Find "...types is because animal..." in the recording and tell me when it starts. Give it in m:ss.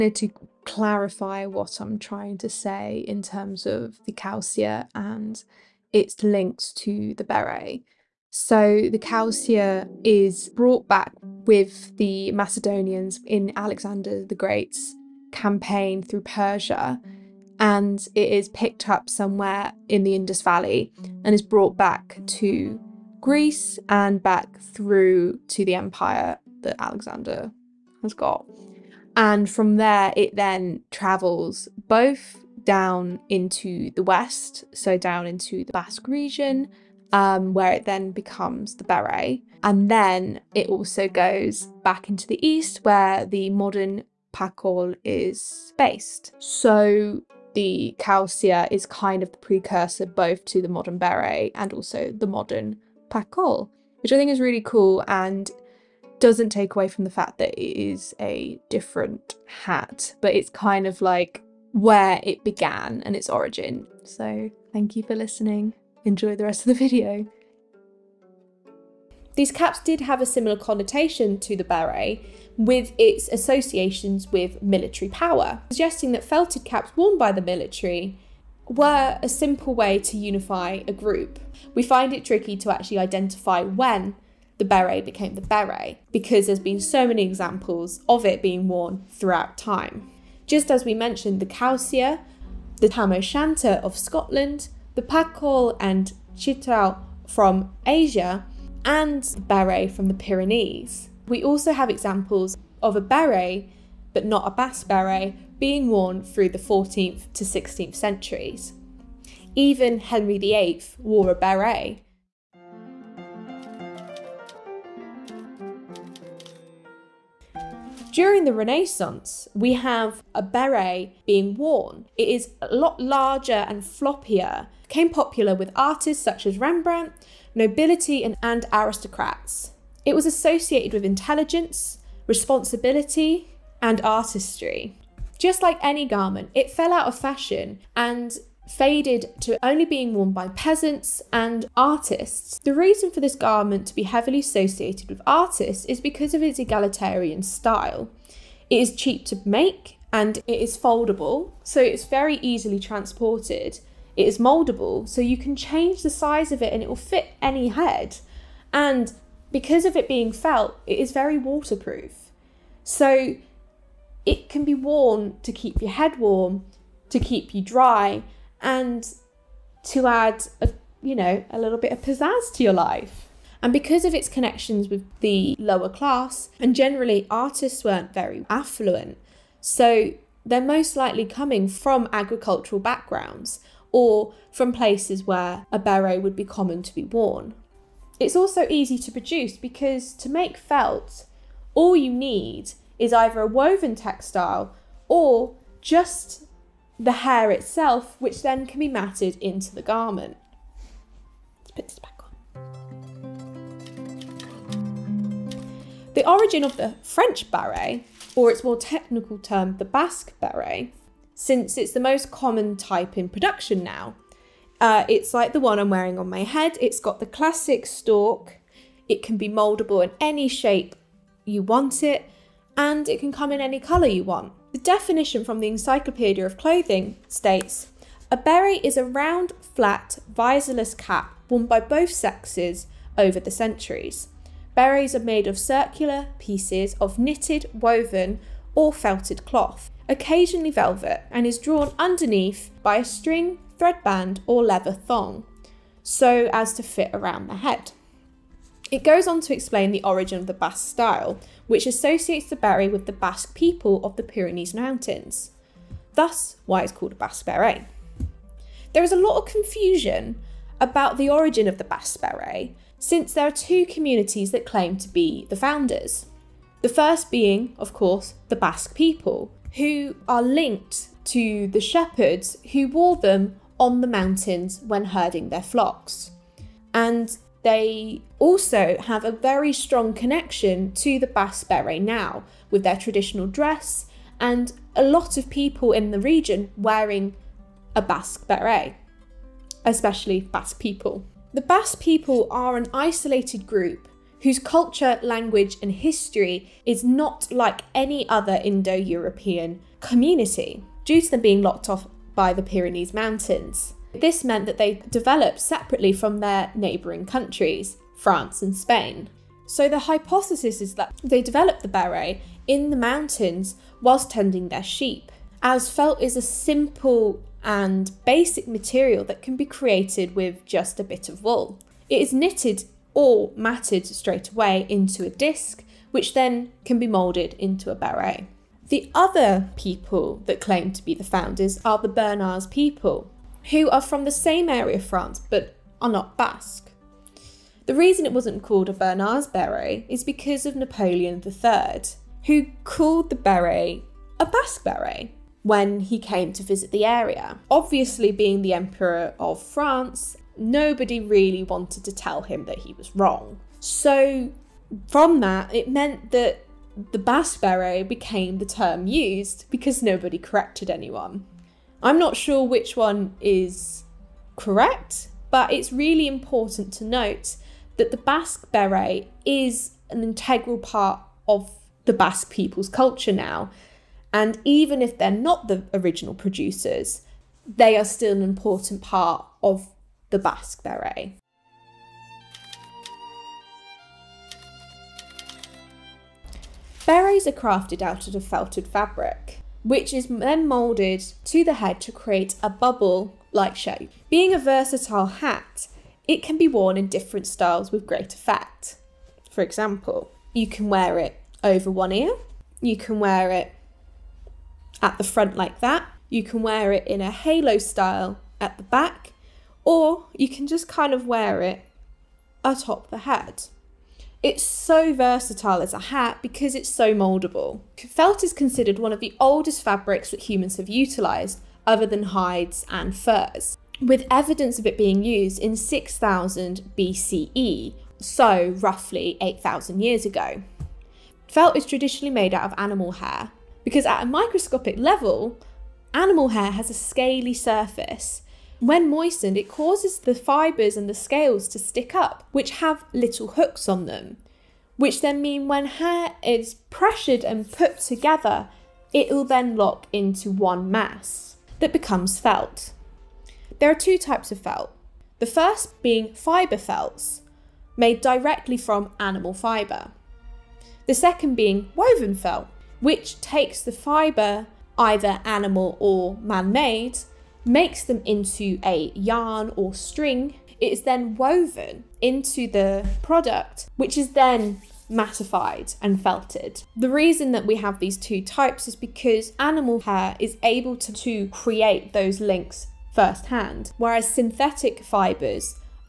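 7:58.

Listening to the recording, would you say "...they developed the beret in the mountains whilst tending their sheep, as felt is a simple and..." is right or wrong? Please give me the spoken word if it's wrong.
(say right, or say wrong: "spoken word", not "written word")
right.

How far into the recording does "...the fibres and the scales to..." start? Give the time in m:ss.
7:20.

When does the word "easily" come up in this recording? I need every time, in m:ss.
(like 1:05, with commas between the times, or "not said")
2:32.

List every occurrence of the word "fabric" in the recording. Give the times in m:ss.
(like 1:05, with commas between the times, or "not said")
6:28, 6:59.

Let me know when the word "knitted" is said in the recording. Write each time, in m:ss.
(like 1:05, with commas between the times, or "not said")
3:57, 5:22.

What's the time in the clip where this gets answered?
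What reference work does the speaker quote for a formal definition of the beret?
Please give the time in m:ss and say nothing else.
3:45.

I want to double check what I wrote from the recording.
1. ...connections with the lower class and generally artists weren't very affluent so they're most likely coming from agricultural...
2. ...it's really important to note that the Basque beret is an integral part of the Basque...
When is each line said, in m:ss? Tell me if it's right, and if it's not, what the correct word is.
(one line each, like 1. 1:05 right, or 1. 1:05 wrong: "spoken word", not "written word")
1. 2:54 right
2. 6:05 right.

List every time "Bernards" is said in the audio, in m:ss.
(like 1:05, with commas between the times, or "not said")
5:32, 5:38.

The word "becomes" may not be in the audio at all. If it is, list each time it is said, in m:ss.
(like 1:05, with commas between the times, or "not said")
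0:38, 7:31.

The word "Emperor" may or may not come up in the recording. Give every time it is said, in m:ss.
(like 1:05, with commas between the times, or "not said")
5:48.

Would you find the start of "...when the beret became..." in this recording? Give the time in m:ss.
1:23.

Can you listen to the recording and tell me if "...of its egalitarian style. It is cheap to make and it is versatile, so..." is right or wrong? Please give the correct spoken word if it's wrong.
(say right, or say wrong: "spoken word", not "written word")
wrong: "foldable", not "versatile".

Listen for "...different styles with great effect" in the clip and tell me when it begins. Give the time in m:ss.
6:37.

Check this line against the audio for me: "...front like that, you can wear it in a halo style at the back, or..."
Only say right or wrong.
right.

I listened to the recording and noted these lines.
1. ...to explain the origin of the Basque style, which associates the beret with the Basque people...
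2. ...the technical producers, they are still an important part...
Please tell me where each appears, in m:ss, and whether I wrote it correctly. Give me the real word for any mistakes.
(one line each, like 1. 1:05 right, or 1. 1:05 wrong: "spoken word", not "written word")
1. 4:09 right
2. 6:15 wrong: "original", not "technical".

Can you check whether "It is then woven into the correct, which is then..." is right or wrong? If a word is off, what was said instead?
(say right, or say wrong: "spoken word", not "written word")
wrong: "product", not "correct".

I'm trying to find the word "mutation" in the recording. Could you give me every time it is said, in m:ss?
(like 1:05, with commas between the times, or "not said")
not said.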